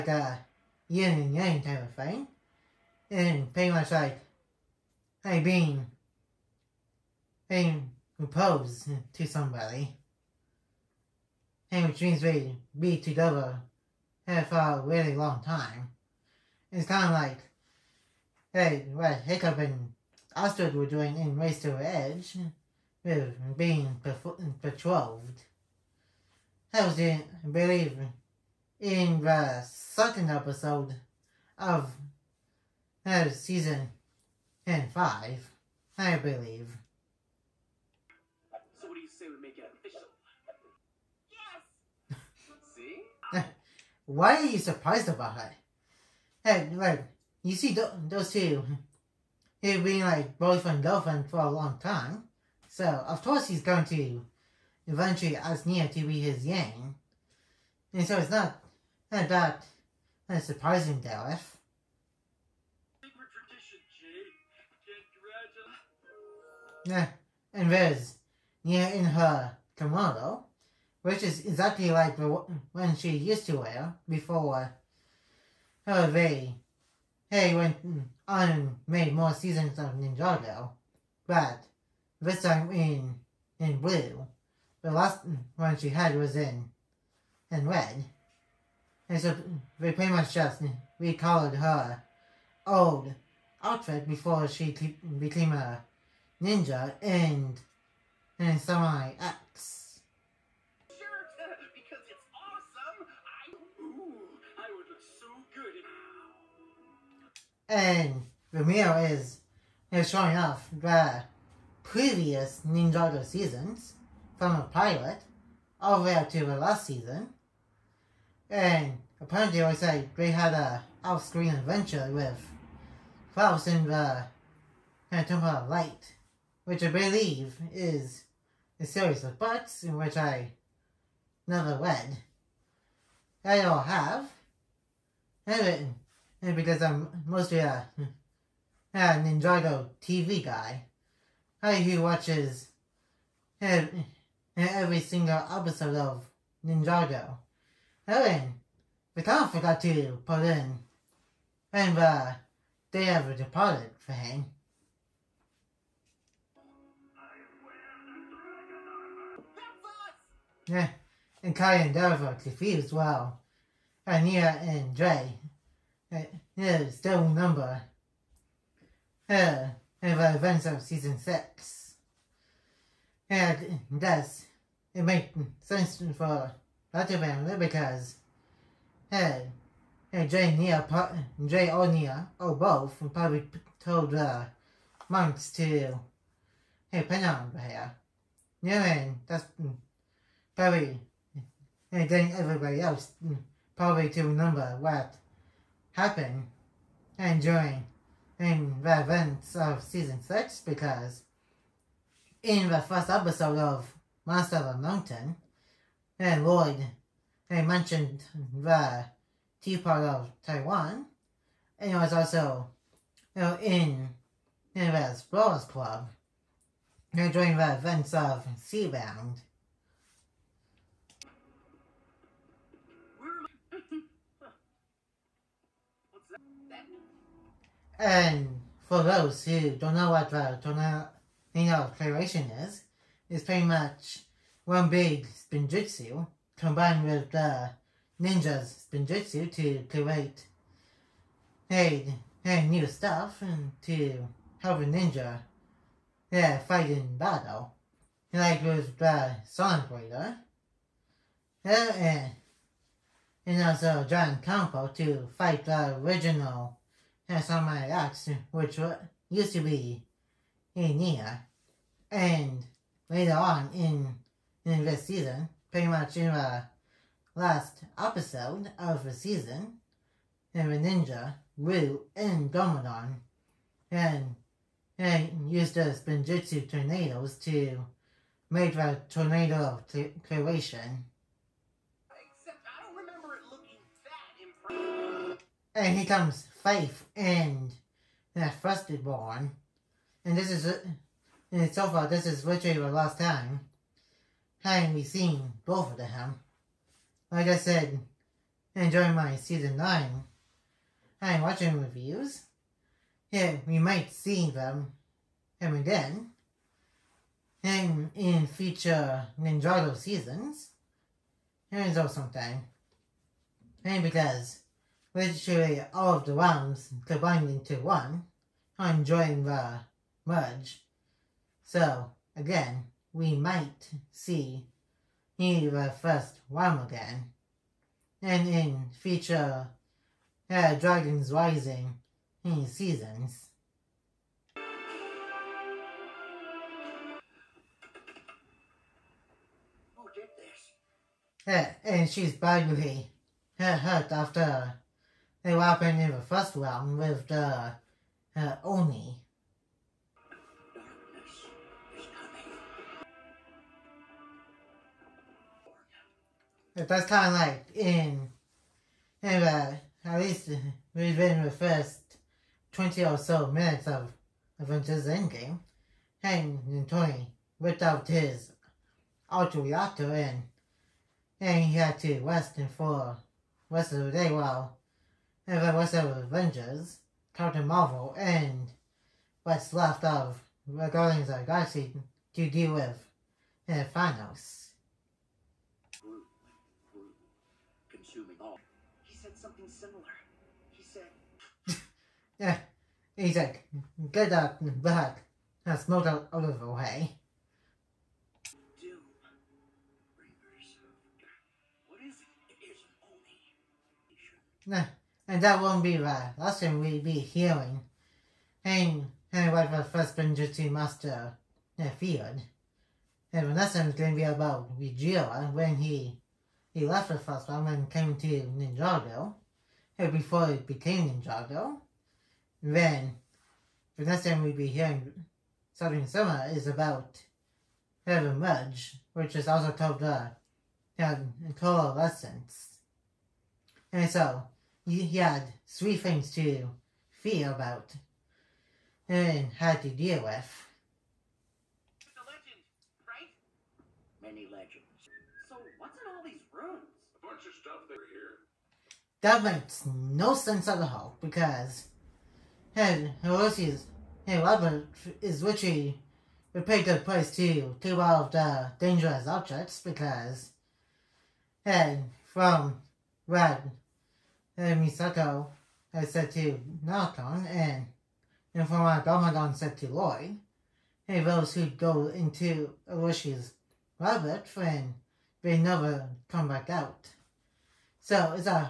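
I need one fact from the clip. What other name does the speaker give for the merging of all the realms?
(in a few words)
Coalescence.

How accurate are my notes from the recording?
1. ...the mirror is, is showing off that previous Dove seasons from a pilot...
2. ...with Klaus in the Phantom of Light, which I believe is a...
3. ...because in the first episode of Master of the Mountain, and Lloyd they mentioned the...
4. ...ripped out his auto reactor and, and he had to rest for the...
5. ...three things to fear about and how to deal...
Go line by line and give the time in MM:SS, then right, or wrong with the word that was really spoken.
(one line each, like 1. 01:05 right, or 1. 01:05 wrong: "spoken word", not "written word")
1. 01:48 wrong: "Ninjago", not "Dove"
2. 02:02 right
3. 03:20 right
4. 06:07 right
5. 07:15 right.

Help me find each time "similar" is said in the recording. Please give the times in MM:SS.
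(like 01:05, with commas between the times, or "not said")
07:06.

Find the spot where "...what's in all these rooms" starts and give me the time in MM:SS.
07:25.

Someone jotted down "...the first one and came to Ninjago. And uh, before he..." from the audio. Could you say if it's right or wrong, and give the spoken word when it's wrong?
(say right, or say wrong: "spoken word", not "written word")
right.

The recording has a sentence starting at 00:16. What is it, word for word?
It's kind of like hey, what Hiccup and Astrid were doing in Race to Edge being patrolled.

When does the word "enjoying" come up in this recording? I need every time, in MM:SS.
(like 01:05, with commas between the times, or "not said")
04:58, 05:18.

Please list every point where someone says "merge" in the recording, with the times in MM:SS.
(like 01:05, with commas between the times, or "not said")
05:20, 07:08.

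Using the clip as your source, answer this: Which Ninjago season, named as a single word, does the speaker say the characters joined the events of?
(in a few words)
Skybound.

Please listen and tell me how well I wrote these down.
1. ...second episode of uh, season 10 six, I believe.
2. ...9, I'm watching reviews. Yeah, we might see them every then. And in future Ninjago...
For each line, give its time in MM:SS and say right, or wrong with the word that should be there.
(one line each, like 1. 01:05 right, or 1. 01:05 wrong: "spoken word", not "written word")
1. 00:29 wrong: "five", not "six"
2. 04:59 right.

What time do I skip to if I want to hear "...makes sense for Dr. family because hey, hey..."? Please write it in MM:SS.
02:55.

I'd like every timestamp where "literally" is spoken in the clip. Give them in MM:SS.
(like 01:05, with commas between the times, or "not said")
04:52, 05:15, 07:35.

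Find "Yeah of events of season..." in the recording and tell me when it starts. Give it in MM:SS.
02:49.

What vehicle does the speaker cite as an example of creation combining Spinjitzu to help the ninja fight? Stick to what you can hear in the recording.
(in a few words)
Sonic Raider.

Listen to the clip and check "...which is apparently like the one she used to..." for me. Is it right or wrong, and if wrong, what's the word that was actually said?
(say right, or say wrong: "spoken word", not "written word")
wrong: "exactly", not "apparently".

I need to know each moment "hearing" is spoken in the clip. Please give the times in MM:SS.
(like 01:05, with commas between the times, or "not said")
06:47, 07:04.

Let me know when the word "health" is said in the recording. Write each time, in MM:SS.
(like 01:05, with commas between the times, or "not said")
not said.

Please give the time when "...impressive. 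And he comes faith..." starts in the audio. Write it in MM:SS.
04:45.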